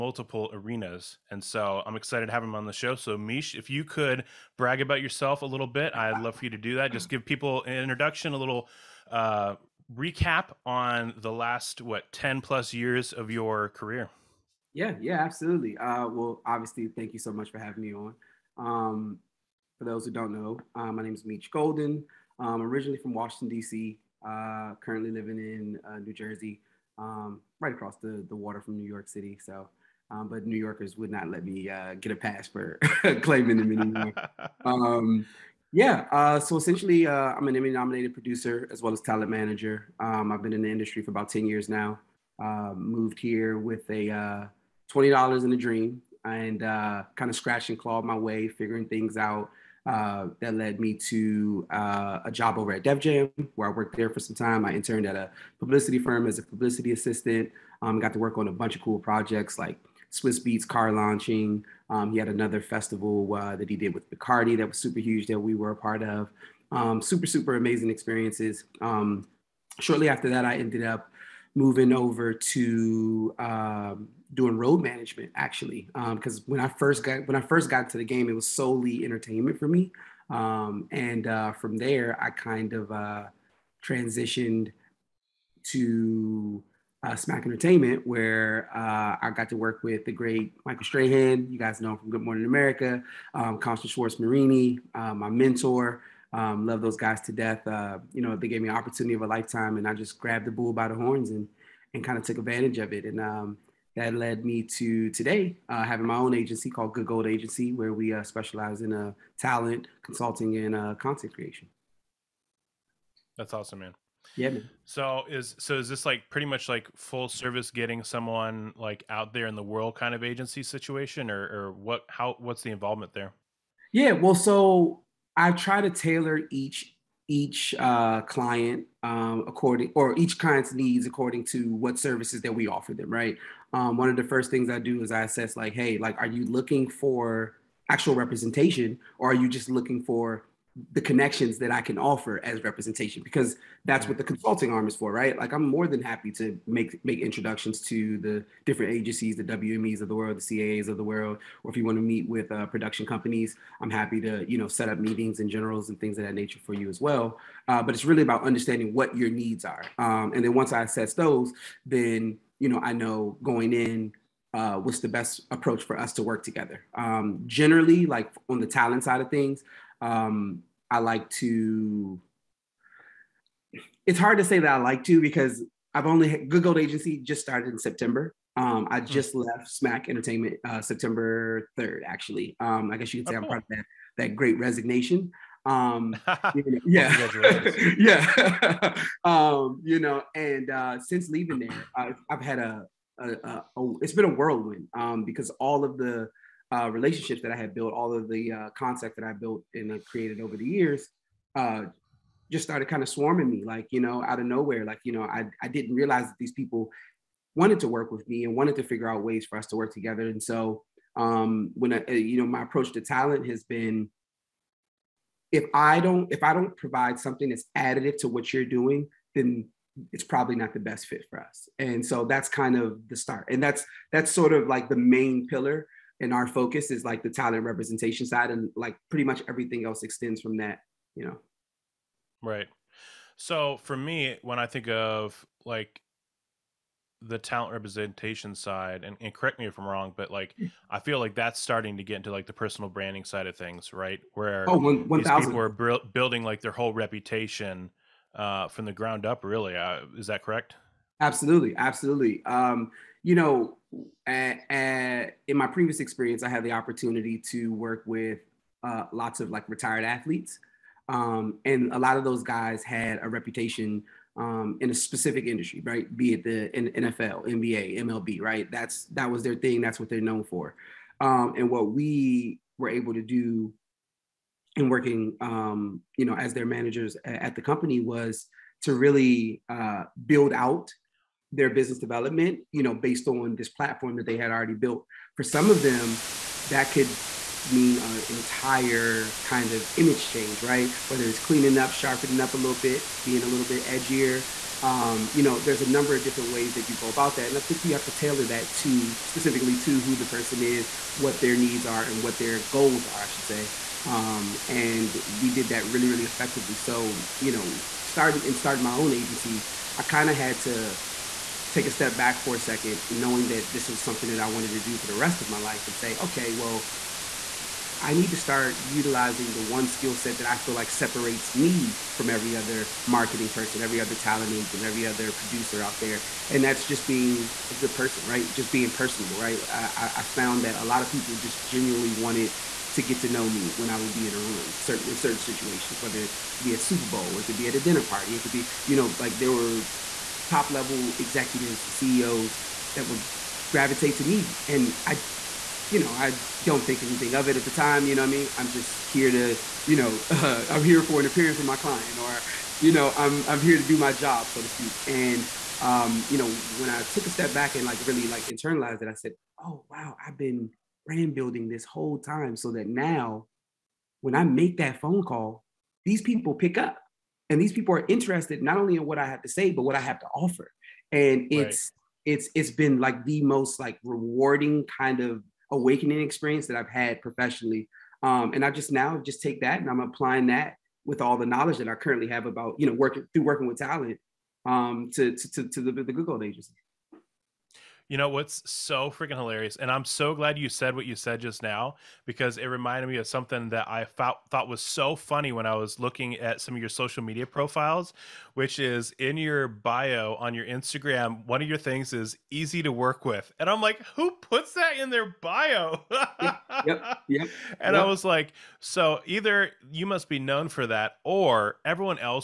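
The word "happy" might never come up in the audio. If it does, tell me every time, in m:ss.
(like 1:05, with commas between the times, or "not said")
2:26, 2:33.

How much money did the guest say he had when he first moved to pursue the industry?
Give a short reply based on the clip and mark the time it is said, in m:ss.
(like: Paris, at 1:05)
$20, at 0:44.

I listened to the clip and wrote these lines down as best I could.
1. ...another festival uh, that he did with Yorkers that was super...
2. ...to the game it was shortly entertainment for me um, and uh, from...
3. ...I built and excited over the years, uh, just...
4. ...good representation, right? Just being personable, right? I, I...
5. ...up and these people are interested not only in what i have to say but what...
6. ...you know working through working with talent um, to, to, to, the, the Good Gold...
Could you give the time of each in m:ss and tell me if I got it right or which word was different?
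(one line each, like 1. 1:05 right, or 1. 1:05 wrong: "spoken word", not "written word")
1. 1:02 wrong: "Bacardi", not "Yorkers"
2. 1:17 wrong: "solely", not "shortly"
3. 3:19 wrong: "created", not "excited"
4. 5:27 wrong: "person", not "representation"
5. 6:06 right
6. 6:22 right.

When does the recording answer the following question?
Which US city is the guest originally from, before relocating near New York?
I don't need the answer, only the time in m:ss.
0:23.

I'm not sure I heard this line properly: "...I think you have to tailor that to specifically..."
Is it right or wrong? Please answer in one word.
right.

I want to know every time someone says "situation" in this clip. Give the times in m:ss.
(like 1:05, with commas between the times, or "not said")
2:00, 5:35.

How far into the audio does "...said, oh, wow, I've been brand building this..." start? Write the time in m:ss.
5:59.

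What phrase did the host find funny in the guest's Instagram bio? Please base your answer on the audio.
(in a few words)
easy to work with.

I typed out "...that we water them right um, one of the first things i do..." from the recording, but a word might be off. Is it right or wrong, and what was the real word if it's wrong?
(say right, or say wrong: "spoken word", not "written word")
wrong: "offer", not "water".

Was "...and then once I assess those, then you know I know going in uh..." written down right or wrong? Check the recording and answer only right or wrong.
right.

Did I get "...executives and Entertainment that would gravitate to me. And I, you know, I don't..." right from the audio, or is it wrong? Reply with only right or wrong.
wrong.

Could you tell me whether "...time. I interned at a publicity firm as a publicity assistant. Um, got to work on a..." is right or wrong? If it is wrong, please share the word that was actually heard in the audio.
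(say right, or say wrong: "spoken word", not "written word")
right.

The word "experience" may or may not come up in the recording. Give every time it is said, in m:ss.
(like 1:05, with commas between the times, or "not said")
1:07, 4:15, 6:16.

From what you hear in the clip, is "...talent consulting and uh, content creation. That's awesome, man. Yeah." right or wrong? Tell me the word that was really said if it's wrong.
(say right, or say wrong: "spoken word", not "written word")
right.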